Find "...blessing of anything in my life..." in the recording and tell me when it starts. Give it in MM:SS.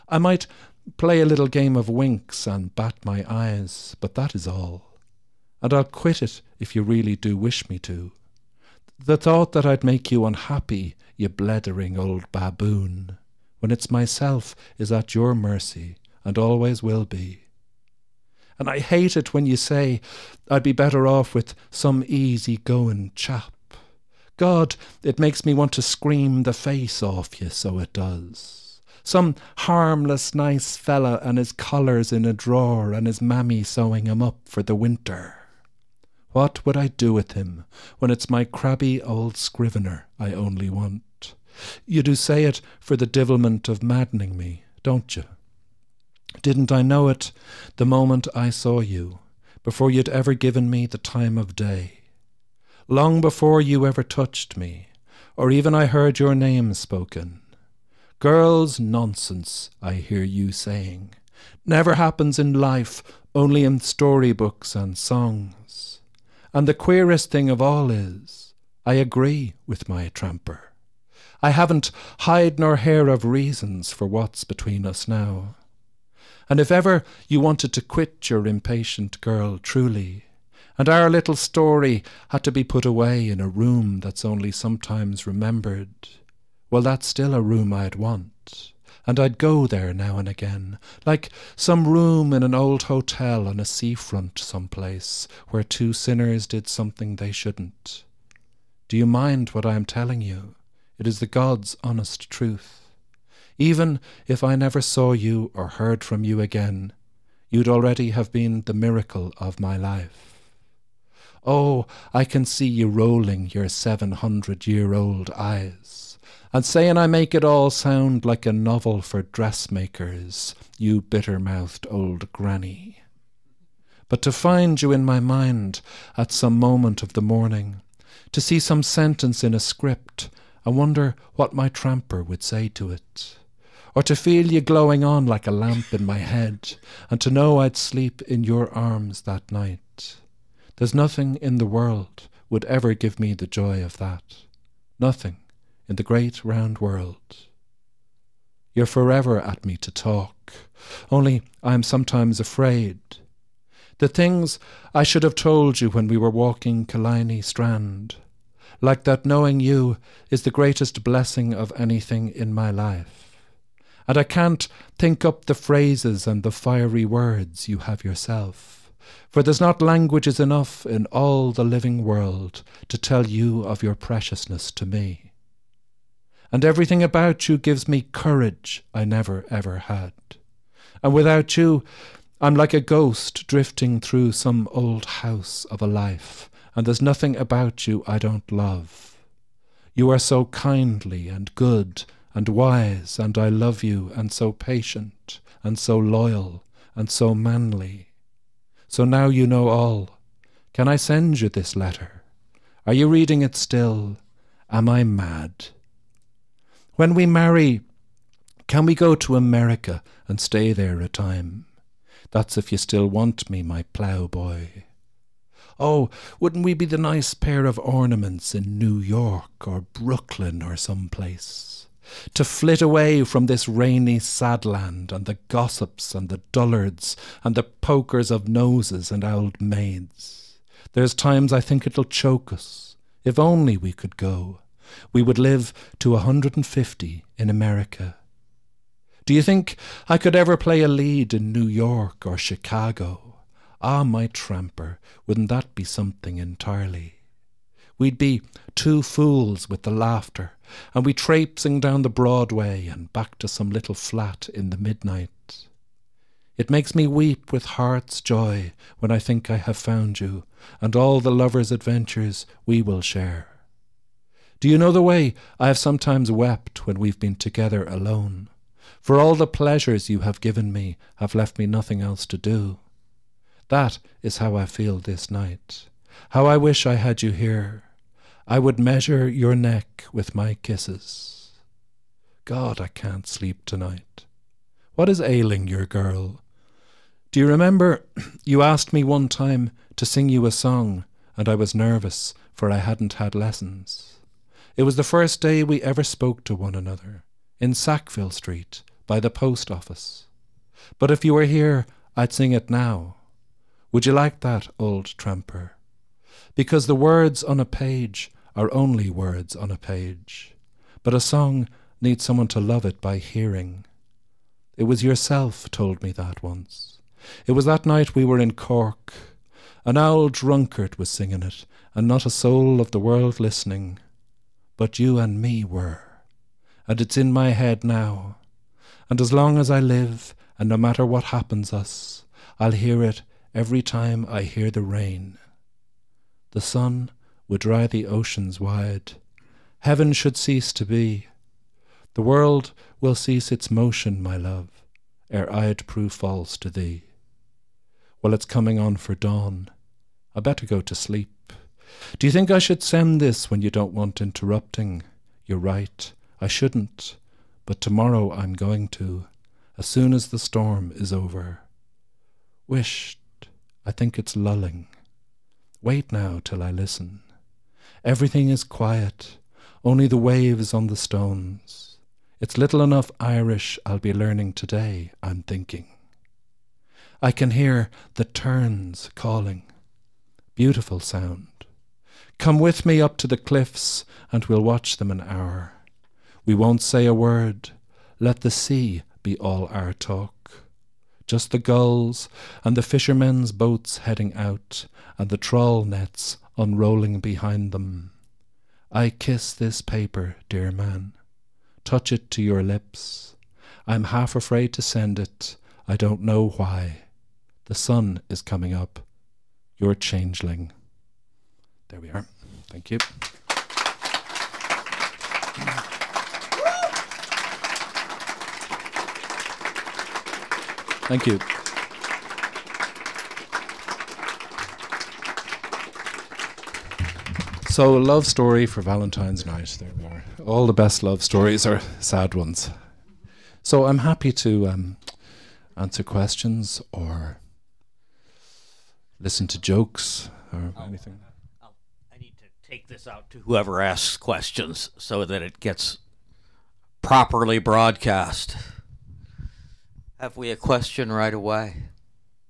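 02:41.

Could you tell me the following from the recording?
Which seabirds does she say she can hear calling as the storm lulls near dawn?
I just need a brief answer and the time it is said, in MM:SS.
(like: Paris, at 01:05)
terns, at 06:18.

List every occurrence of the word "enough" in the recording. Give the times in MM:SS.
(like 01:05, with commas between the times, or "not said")
02:50, 06:12.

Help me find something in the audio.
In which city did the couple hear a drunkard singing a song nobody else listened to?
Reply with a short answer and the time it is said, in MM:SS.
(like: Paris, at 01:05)
Cork, at 05:18.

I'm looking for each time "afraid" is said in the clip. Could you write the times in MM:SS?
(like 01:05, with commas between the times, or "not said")
02:32, 06:44.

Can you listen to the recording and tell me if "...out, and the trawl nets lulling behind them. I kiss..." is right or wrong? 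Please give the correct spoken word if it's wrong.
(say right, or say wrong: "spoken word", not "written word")
wrong: "unrolling", not "lulling".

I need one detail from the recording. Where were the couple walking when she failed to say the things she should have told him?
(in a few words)
Killiney Strand.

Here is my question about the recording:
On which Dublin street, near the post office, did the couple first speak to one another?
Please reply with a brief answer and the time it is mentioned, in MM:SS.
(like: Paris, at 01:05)
Sackville Street, at 04:57.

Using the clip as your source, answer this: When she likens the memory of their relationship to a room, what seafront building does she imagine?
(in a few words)
old hotel.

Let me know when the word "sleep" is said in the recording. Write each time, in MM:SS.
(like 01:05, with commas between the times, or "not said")
02:17, 04:43, 05:50.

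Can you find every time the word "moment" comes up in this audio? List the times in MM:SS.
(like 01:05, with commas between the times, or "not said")
00:47, 02:06.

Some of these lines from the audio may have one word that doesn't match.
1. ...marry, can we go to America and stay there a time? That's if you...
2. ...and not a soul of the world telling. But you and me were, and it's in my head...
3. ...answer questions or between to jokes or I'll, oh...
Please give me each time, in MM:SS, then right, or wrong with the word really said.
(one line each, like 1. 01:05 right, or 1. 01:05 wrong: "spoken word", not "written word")
1. 03:27 right
2. 05:21 wrong: "listening", not "telling"
3. 07:15 wrong: "listen", not "between".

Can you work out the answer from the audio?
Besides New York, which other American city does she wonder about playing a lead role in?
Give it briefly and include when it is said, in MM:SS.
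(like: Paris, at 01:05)
Chicago, at 04:02.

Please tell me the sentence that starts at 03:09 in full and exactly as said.
You are so kindly and good and wise, and I love you, and so patient, and so loyal, and so manly.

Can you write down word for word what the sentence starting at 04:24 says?
Do you know the way I have sometimes wept when we've been together alone?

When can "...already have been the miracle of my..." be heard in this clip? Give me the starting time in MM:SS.
01:47.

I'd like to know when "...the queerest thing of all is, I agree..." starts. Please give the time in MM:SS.
01:06.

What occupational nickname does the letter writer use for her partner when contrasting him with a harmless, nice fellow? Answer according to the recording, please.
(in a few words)
crabby old scrivener.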